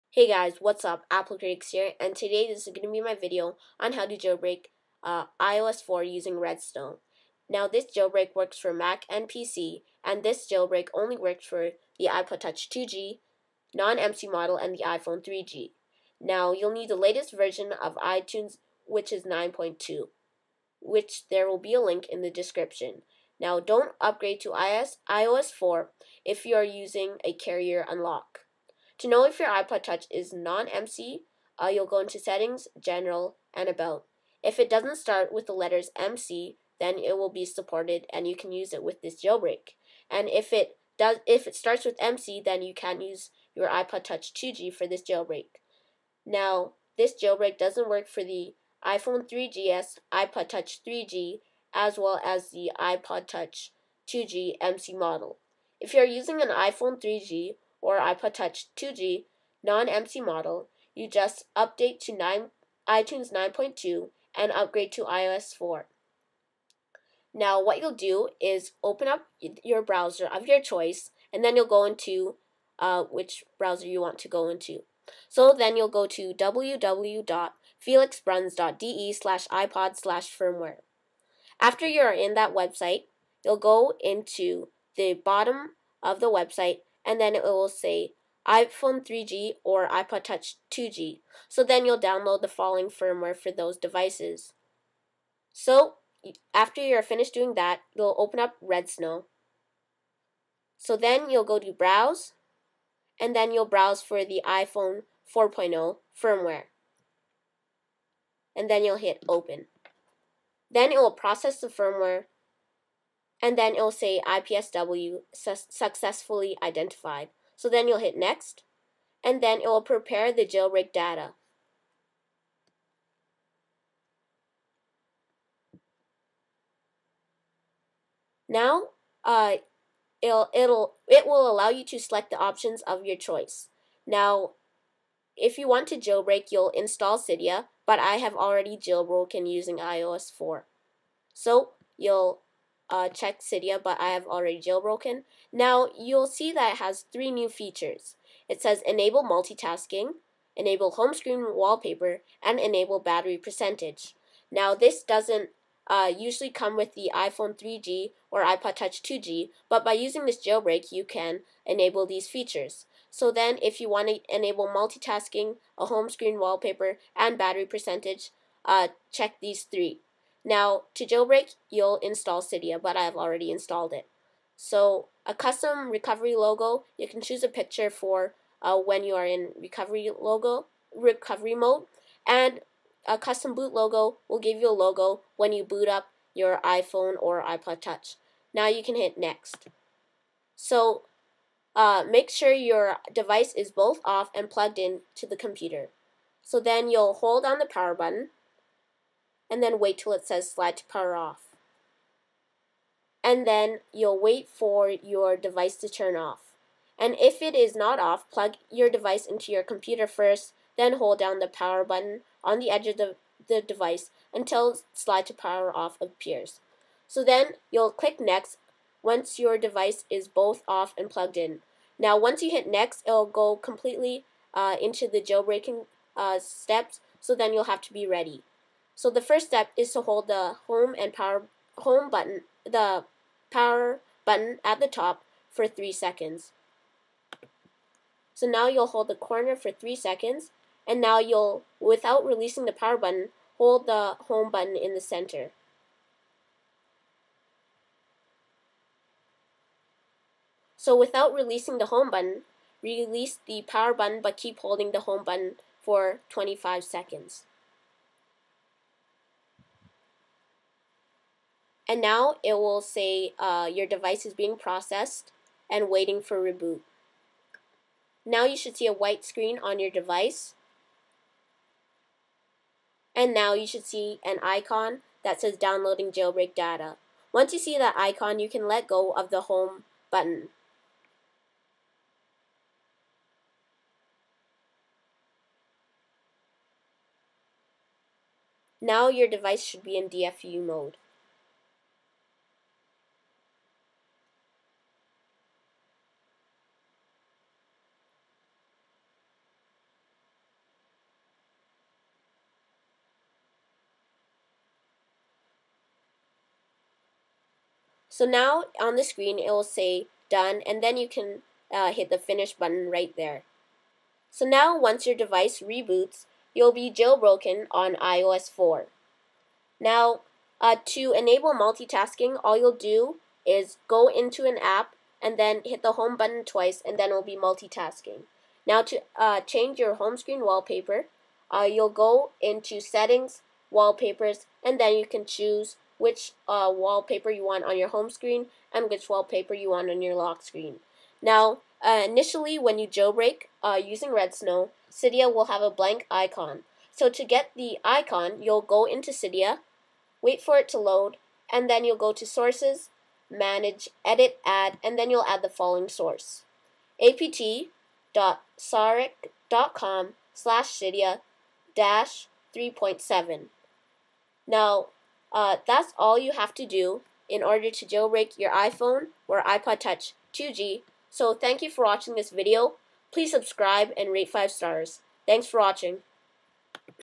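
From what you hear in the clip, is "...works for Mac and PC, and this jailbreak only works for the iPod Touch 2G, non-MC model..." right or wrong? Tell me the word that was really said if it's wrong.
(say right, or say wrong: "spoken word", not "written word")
right.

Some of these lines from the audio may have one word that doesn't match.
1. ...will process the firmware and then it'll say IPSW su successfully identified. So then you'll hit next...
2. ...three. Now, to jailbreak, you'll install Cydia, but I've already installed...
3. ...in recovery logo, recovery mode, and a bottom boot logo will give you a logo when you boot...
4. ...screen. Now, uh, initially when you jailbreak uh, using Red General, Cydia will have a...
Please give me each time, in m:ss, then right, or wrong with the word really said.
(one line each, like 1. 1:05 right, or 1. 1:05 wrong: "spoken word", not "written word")
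1. 1:50 right
2. 2:49 right
3. 2:59 wrong: "custom", not "bottom"
4. 5:40 wrong: "Snow", not "General".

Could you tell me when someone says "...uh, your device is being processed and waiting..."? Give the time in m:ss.
4:23.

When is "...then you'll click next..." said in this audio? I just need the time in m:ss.
3:37.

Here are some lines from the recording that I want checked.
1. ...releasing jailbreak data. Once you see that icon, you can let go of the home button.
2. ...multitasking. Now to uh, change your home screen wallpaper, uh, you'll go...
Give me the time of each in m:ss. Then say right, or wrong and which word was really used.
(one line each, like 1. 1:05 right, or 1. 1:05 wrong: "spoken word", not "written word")
1. 4:35 wrong: "downloading", not "releasing"
2. 5:27 right.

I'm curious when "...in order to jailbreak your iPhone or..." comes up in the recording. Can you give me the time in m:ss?
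6:07.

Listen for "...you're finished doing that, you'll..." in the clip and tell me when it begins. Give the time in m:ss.
1:36.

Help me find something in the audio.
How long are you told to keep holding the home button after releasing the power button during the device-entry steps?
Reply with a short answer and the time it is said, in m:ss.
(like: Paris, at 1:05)
25 seconds, at 4:16.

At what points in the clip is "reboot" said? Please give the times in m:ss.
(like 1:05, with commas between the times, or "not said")
4:26, 5:15.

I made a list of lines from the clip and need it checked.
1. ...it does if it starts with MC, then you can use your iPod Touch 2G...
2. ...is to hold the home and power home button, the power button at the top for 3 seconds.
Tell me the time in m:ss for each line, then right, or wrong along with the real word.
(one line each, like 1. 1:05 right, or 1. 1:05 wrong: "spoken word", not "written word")
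1. 0:40 right
2. 3:49 right.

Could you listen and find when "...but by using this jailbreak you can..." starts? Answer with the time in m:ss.
2:39.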